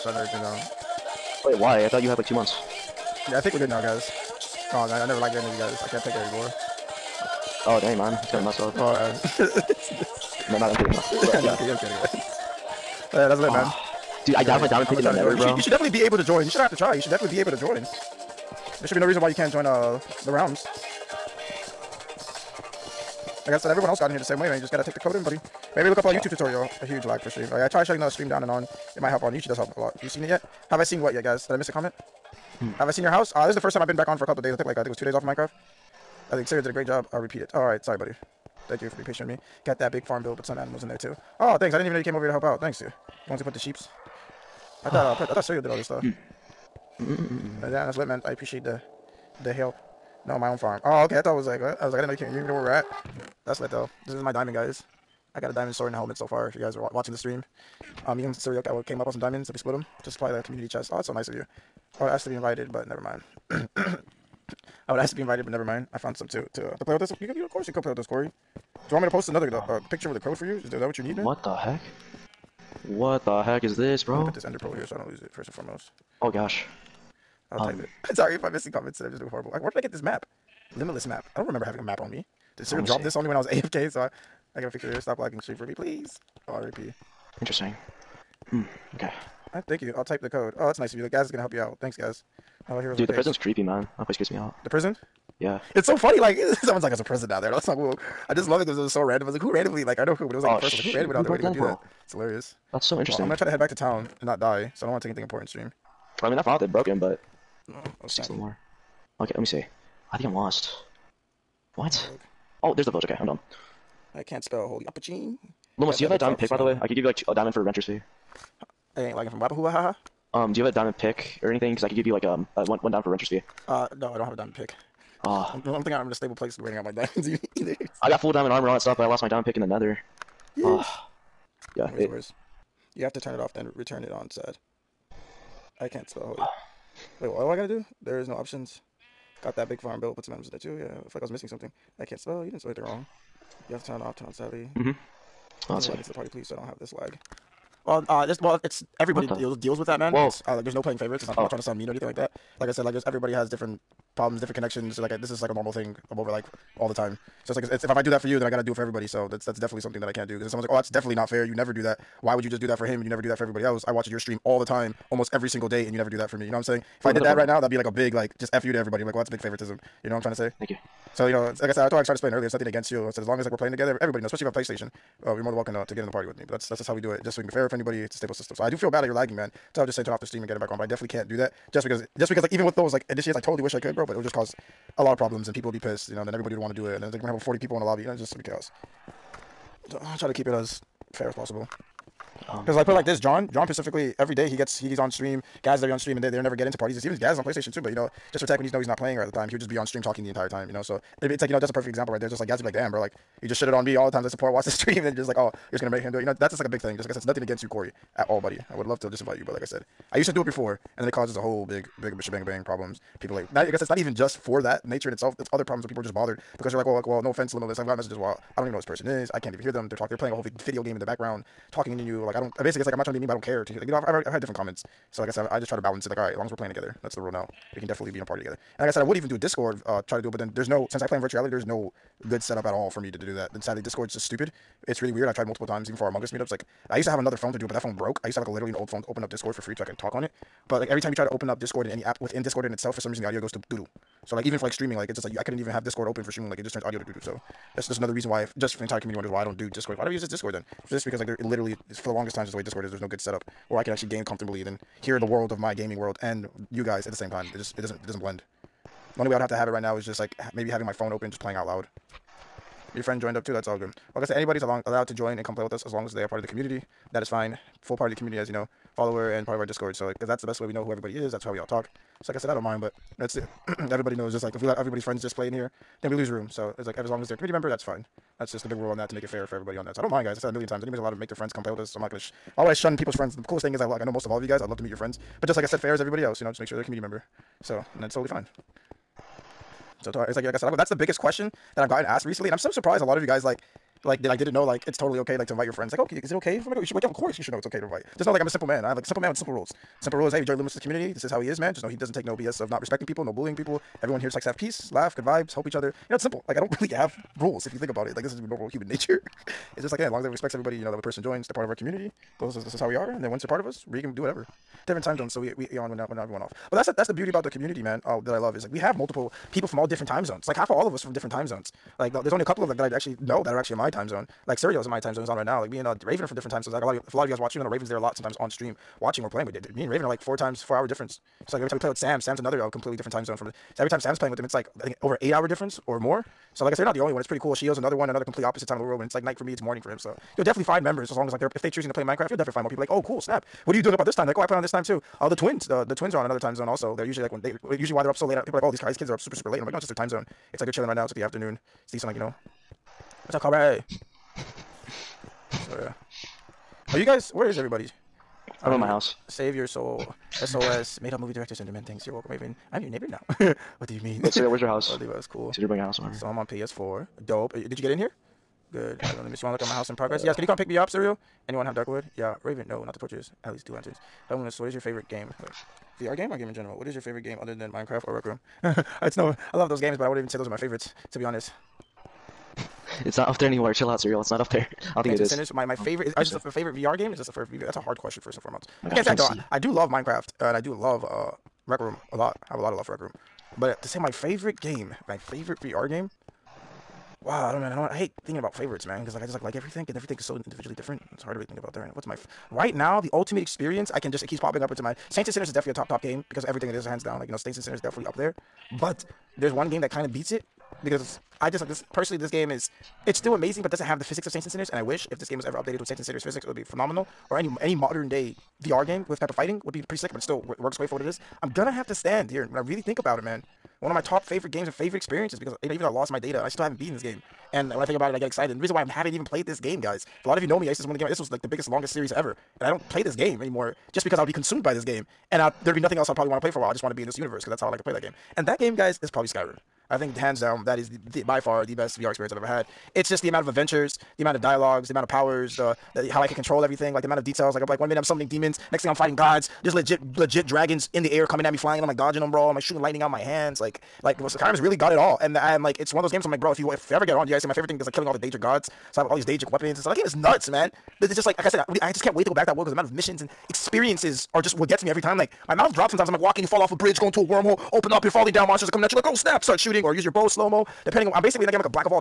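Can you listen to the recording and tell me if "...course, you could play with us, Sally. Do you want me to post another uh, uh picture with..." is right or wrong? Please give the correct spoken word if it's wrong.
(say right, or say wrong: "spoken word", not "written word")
wrong: "Corey", not "Sally".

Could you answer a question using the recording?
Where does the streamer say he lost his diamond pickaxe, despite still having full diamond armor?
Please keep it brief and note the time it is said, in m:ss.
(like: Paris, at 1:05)
The nether, at 2:09.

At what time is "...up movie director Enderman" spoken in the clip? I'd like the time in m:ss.
6:01.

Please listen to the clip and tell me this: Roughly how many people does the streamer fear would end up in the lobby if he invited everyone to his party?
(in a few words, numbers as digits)
Over 40.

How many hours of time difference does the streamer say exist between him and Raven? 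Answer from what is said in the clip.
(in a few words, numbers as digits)
4.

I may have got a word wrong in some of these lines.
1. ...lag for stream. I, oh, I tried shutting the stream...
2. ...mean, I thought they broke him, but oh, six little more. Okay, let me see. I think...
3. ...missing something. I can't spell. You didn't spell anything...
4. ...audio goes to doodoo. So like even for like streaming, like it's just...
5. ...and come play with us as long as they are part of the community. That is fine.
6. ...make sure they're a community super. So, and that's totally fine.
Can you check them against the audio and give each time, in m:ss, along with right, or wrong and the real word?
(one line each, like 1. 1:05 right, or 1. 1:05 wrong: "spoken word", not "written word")
1. 0:27 right
2. 1:46 right
3. 2:21 right
4. 4:03 right
5. 4:25 right
6. 4:46 wrong: "member", not "super".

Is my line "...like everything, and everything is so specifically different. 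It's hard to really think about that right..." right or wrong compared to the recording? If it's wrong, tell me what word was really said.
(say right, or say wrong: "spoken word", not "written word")
wrong: "individually", not "specifically".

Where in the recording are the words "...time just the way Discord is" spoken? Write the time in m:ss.
4:12.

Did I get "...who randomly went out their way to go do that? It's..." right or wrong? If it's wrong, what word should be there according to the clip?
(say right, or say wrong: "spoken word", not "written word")
right.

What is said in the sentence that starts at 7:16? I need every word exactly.
I just want to be in this universe because that's how I like to play that game.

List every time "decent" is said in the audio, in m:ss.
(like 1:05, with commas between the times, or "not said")
5:51.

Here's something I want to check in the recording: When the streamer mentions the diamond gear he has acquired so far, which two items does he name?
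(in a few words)
Diamond sword and helmet.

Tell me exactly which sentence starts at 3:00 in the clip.
But I definitely can't do that, just because, just because, like even with those like initiates, I totally wish I could, bro.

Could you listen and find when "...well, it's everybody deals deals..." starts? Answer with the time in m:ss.
2:28.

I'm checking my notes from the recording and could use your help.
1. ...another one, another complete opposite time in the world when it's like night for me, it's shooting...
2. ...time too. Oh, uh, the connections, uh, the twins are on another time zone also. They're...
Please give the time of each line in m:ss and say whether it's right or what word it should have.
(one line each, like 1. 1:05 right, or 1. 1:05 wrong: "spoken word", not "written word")
1. 5:37 wrong: "morning", not "shooting"
2. 5:44 wrong: "twins", not "connections".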